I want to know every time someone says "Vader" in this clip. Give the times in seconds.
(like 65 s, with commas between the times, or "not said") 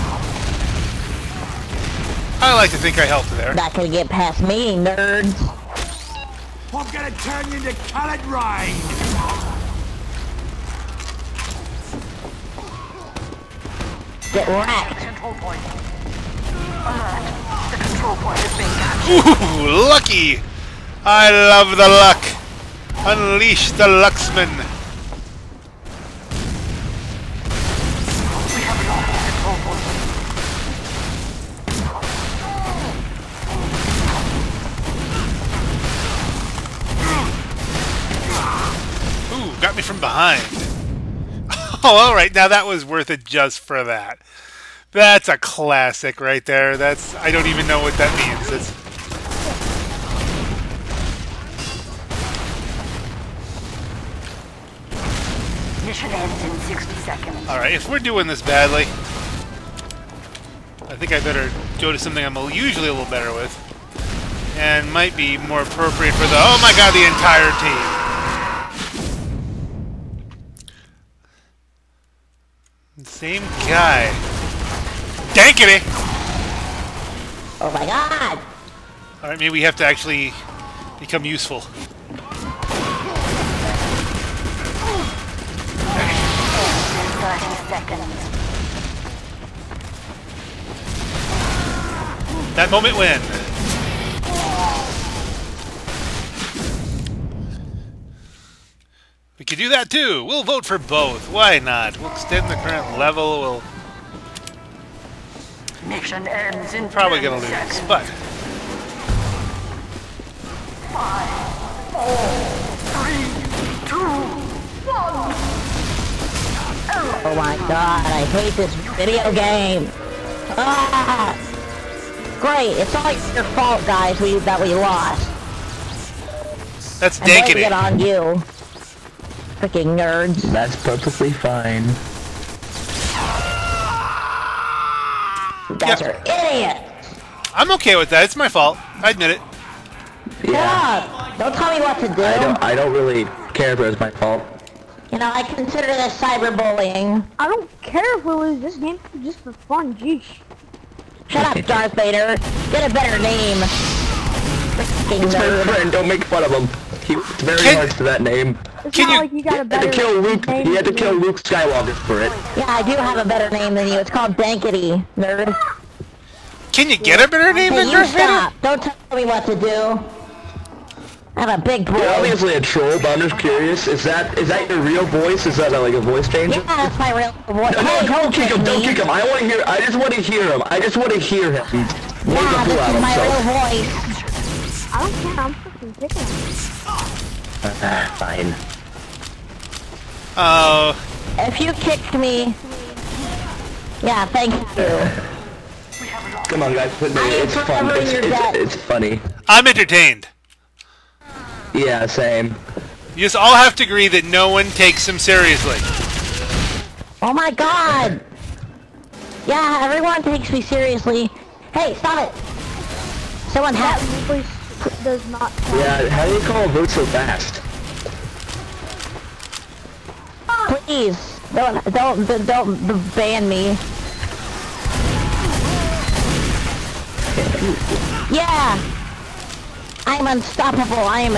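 151 s, 168 s.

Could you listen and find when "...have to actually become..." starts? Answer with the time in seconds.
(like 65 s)
79 s.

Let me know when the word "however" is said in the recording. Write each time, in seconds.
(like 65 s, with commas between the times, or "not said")
not said.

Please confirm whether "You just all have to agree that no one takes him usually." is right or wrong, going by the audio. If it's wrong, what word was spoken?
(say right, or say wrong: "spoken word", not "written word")
wrong: "seriously", not "usually".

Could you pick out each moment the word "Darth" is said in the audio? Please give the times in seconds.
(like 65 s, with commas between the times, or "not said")
151 s, 167 s.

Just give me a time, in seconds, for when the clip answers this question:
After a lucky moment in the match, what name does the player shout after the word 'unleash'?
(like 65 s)
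23 s.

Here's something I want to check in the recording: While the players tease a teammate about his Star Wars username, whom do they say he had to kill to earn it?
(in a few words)
Luke Skywalker.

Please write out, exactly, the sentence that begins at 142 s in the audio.
I don't, I don't really care if it was my fault.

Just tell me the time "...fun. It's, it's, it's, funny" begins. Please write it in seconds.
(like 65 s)
197 s.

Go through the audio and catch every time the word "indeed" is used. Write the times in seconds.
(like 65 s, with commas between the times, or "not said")
not said.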